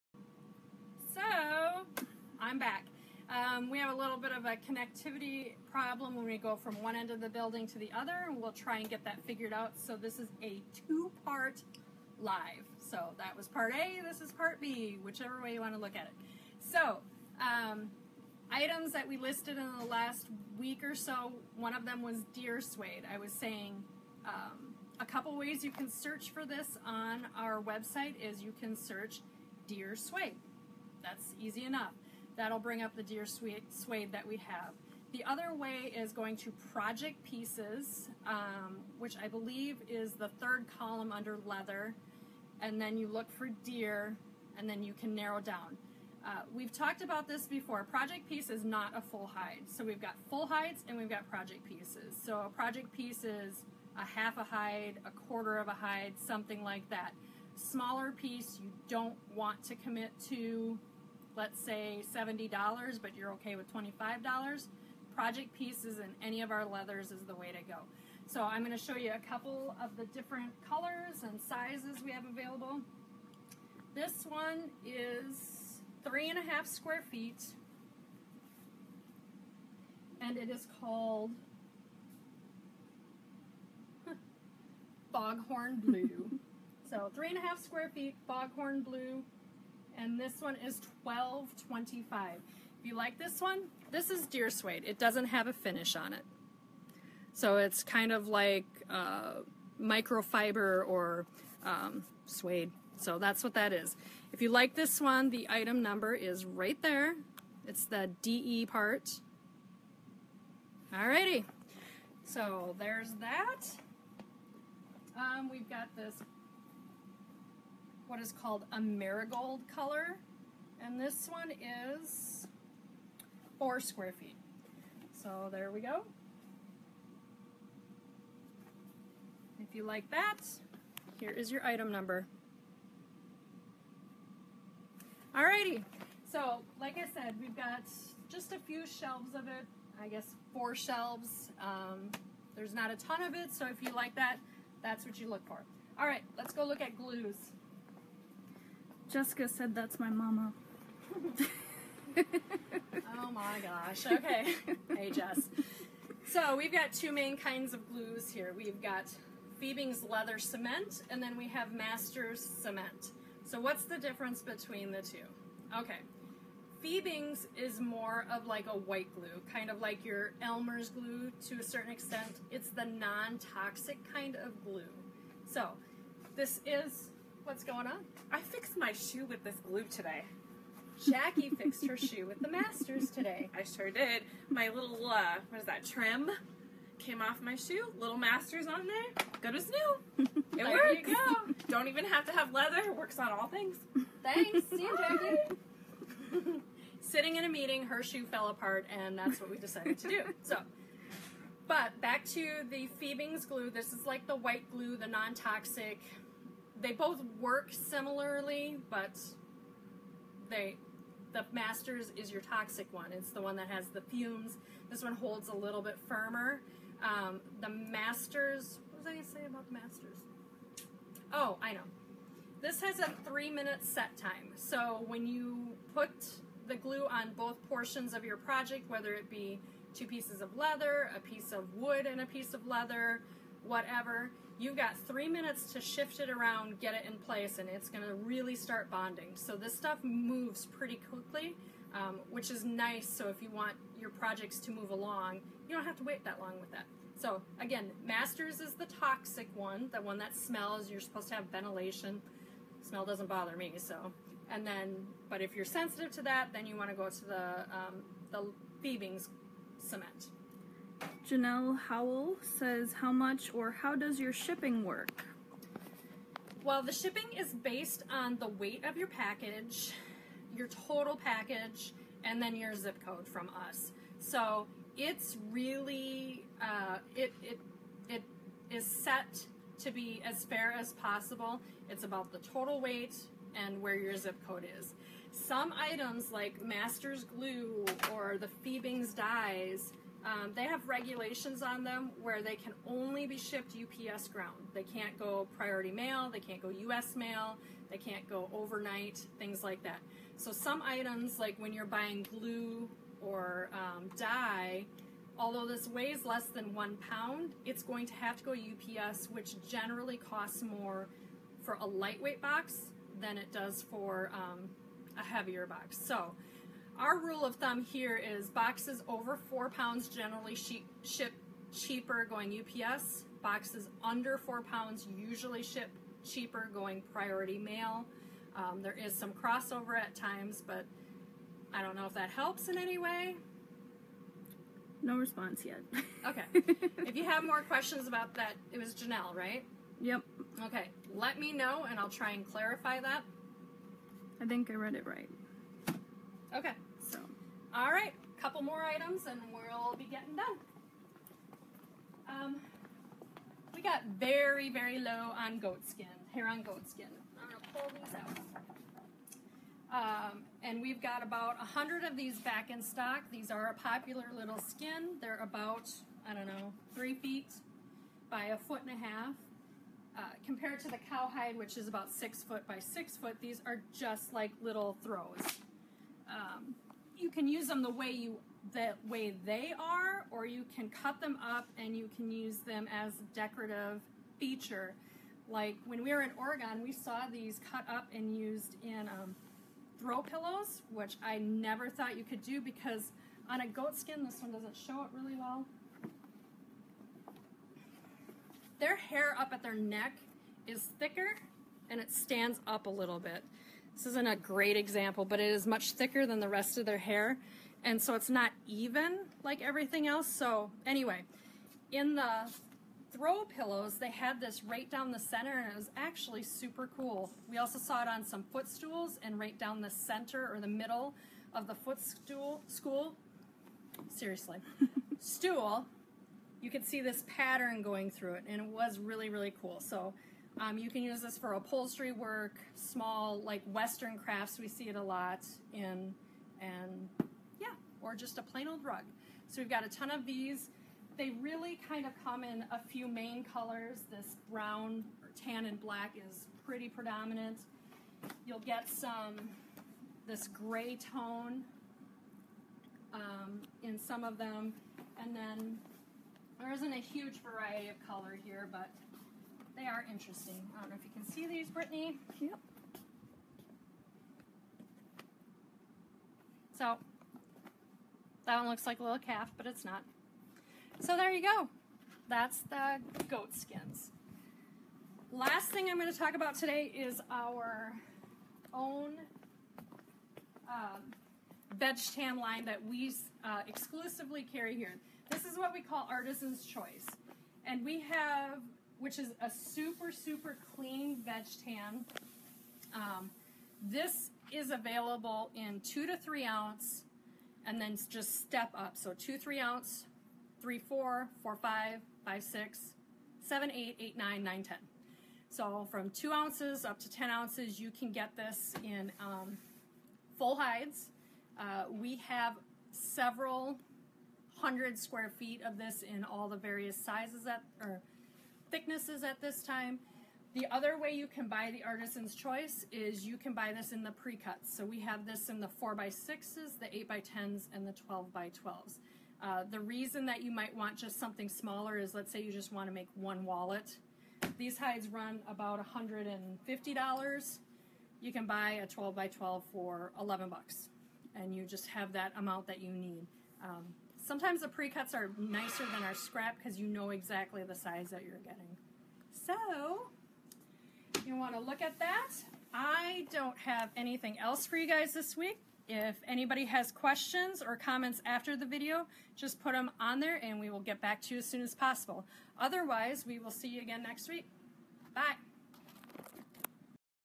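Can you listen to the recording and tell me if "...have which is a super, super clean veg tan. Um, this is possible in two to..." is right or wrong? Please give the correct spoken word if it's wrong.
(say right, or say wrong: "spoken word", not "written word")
wrong: "available", not "possible".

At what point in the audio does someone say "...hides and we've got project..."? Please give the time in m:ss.
0:50.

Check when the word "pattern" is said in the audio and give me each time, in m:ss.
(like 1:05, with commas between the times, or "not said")
7:07.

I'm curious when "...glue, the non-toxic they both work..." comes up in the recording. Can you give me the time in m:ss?
3:24.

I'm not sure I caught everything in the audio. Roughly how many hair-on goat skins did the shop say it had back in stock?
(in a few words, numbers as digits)
100.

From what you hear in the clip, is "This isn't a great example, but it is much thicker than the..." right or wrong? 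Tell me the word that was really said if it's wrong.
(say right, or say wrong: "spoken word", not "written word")
right.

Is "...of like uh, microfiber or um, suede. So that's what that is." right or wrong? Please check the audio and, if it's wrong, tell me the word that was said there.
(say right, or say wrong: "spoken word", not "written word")
right.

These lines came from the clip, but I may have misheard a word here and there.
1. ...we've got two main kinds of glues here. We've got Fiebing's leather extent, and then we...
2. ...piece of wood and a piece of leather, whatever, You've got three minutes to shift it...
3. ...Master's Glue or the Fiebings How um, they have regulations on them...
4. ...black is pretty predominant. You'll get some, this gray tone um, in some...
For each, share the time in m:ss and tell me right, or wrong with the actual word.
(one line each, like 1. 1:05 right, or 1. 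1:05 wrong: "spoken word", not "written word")
1. 2:36 wrong: "cement", not "extent"
2. 3:51 right
3. 4:46 wrong: "Dyes", not "How"
4. 7:25 right.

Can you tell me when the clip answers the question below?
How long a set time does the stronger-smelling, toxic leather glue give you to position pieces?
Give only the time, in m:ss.
3:43.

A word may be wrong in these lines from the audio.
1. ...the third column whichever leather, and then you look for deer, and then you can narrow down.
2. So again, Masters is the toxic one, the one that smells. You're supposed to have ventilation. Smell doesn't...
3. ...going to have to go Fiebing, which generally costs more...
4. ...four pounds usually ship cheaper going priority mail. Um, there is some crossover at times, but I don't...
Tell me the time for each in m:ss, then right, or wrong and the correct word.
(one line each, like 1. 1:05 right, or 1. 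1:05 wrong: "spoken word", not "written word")
1. 0:40 wrong: "under", not "whichever"
2. 4:07 right
3. 5:07 wrong: "UPS", not "Fiebing"
4. 5:24 right.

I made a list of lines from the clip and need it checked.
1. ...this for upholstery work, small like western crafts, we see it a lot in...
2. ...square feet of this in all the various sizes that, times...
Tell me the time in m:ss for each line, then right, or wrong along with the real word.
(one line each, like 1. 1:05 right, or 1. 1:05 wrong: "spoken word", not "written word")
1. 7:11 right
2. 8:34 wrong: "thicknesses", not "times".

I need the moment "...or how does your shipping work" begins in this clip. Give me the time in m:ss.
4:23.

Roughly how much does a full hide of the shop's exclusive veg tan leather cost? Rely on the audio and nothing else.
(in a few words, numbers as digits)
$150.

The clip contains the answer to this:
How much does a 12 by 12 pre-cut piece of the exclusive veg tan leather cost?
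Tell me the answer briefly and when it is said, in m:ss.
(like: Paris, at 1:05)
$11, at 9:00.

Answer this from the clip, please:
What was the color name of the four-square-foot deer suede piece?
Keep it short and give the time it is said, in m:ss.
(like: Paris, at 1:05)
Marigold, at 1:58.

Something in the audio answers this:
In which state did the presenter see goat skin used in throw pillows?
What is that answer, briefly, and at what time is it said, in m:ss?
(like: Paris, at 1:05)
Oregon, at 6:26.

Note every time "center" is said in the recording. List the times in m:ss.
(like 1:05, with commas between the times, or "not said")
6:55, 6:59.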